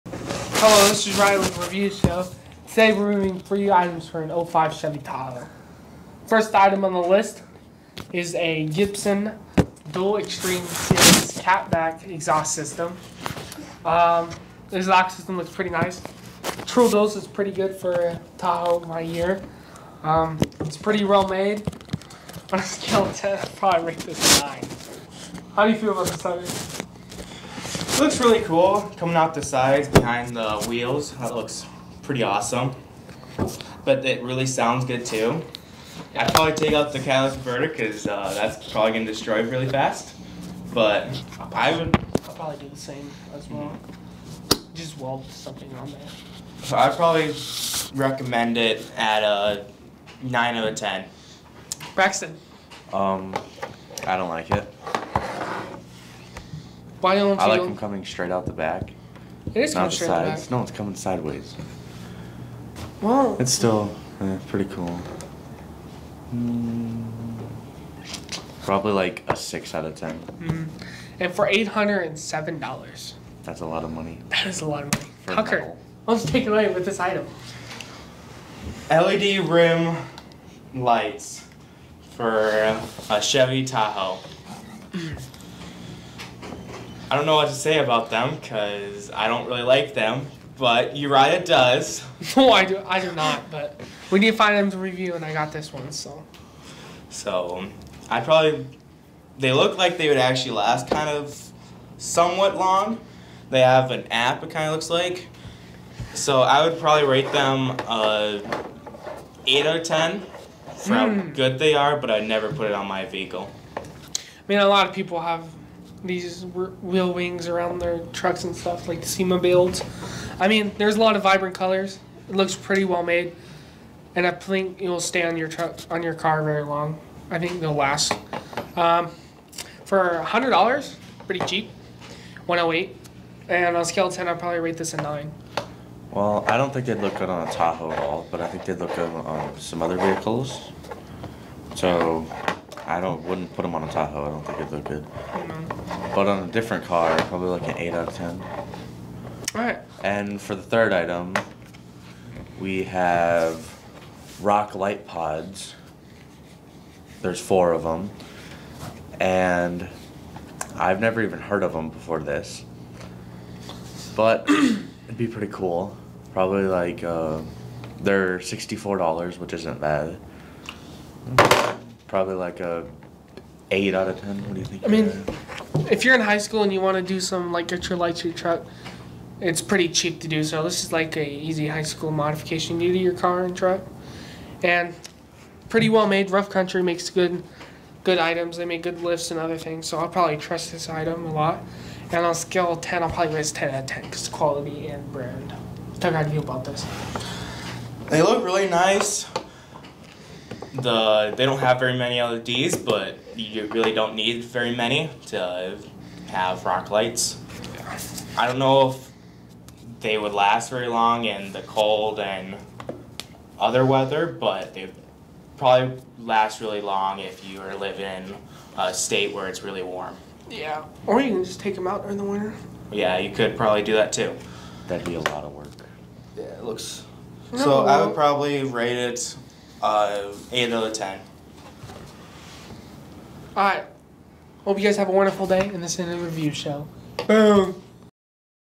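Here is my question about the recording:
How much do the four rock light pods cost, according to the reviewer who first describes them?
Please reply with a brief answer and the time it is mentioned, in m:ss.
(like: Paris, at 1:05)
$64, at 2:48.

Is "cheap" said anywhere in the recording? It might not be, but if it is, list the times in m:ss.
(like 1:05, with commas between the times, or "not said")
2:11, 2:59.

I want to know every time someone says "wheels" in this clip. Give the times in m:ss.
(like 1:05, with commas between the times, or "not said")
0:30, 1:56.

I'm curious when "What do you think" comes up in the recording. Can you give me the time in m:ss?
2:54.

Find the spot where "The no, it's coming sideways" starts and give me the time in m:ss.
1:00.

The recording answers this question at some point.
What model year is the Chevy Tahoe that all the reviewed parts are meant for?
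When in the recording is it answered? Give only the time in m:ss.
0:04.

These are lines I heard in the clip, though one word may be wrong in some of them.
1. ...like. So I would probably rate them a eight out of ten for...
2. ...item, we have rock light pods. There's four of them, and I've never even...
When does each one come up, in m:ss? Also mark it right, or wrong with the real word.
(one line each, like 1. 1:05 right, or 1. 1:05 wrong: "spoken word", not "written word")
1. 1:44 right
2. 2:30 right.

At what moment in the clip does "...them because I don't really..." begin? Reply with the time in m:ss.
1:28.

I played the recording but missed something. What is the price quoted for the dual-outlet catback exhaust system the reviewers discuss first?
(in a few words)
$807.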